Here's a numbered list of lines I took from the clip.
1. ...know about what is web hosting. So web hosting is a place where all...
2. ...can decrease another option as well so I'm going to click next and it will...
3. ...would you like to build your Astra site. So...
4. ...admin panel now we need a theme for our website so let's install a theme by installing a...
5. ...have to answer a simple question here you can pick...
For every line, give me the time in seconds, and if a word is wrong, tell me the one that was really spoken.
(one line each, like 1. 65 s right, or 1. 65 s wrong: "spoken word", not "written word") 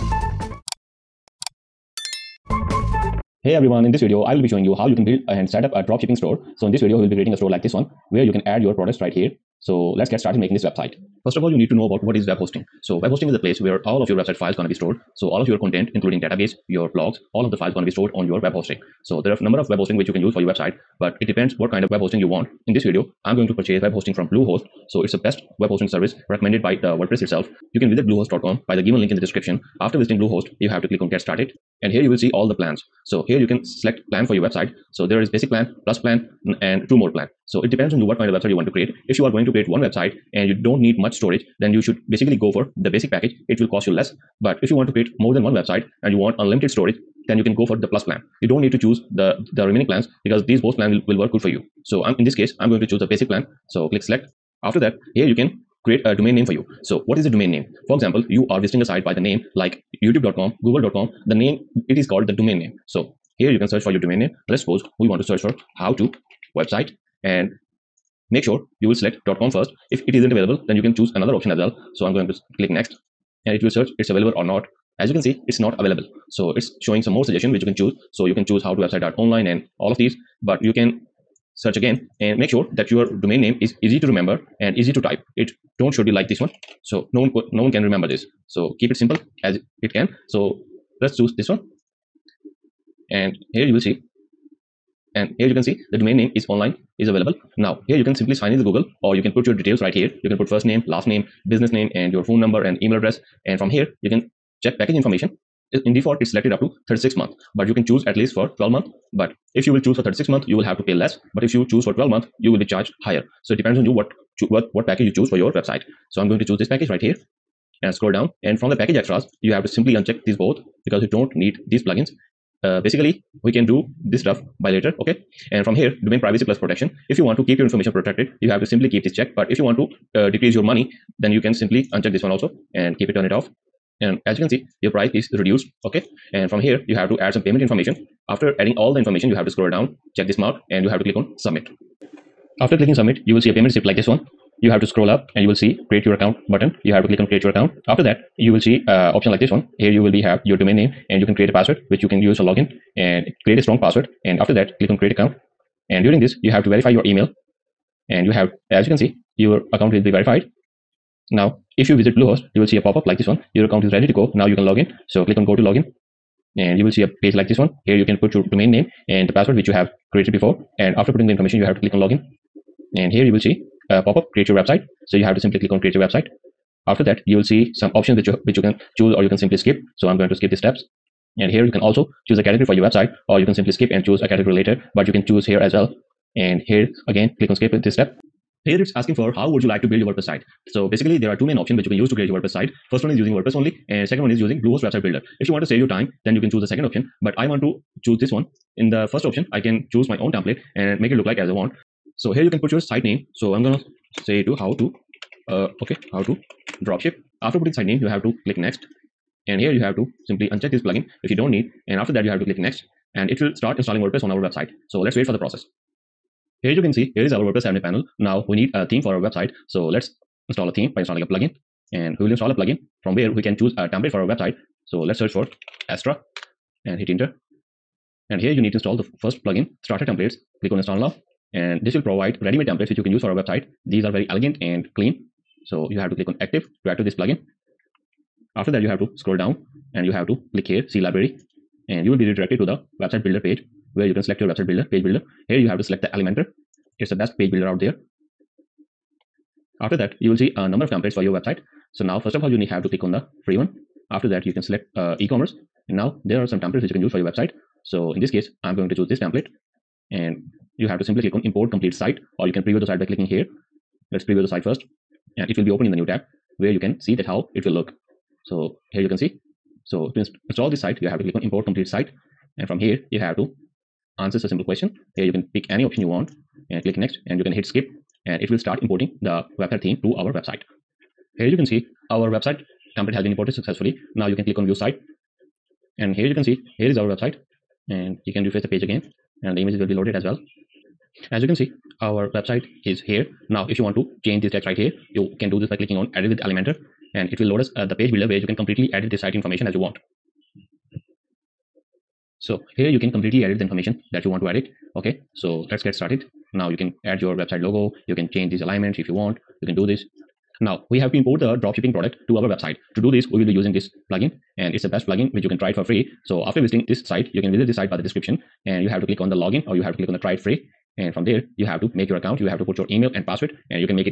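1. 11 s right
2. 70 s wrong: "choose", not "decrease"
3. 189 s wrong: "WordPress", not "Astra"
4. 217 s right
5. 273 s right.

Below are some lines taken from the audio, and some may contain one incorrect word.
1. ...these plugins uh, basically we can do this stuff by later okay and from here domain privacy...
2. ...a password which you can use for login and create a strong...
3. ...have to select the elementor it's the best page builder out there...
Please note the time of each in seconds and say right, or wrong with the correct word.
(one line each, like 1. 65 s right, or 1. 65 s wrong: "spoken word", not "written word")
1. 121 s right
2. 151 s right
3. 245 s right.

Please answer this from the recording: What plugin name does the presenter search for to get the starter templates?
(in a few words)
Astra.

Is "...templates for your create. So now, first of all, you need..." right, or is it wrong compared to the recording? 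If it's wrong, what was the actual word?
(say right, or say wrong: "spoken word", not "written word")
wrong: "website", not "create".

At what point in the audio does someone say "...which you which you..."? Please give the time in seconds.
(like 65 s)
178 s.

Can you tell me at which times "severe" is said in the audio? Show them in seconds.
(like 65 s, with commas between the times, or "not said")
not said.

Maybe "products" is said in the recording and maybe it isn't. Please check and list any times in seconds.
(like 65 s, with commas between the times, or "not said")
8 s, 311 s.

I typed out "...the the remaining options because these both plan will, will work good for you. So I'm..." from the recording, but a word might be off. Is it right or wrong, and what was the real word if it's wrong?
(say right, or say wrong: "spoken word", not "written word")
wrong: "plans", not "options".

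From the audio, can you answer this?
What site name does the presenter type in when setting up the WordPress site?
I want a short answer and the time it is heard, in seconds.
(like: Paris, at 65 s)
how to drop ship, at 206 s.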